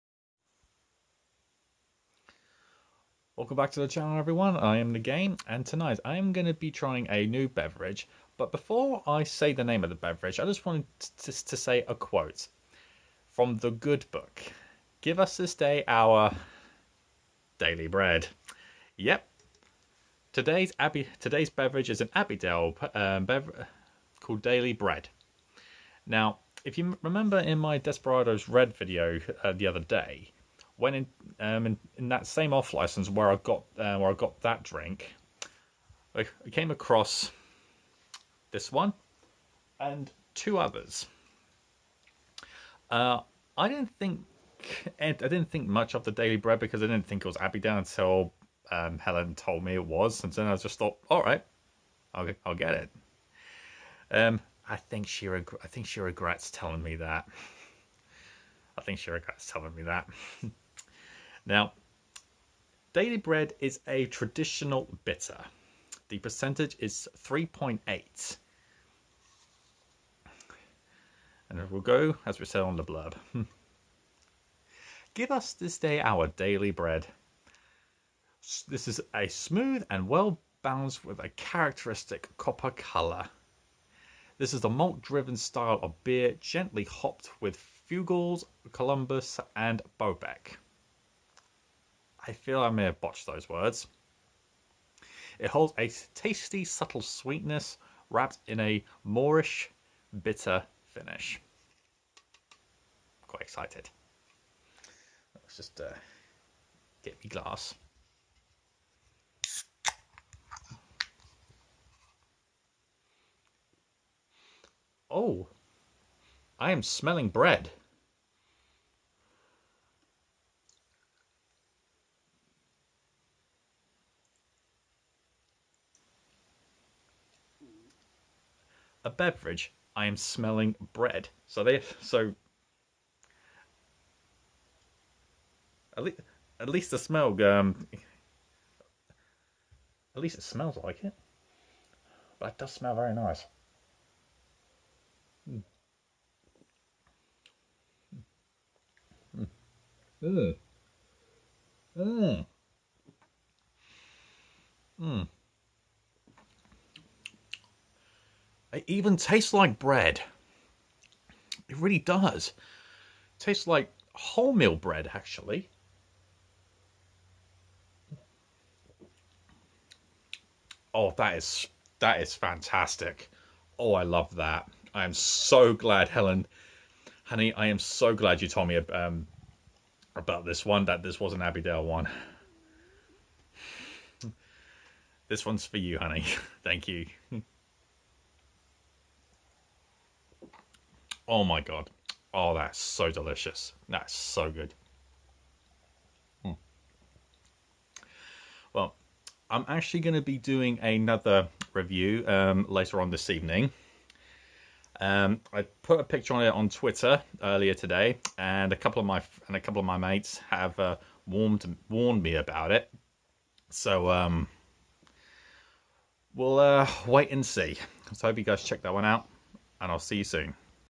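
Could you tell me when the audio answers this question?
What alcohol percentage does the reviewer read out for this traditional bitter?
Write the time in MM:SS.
01:07.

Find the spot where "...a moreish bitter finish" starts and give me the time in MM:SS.
01:38.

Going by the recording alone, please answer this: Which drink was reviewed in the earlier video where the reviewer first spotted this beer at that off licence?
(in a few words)
Desperados Red.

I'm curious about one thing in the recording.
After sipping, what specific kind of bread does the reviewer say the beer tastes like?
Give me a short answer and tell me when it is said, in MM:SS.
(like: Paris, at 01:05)
Wholemeal bread, at 02:44.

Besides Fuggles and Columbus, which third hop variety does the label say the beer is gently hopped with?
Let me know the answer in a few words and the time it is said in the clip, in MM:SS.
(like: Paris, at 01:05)
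Bobek, at 01:29.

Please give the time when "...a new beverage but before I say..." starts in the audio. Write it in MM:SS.
00:07.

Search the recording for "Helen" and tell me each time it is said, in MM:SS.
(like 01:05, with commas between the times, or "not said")
00:48, 02:56.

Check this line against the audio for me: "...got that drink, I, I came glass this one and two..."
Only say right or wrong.
wrong.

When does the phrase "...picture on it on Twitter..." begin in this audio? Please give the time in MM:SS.
03:26.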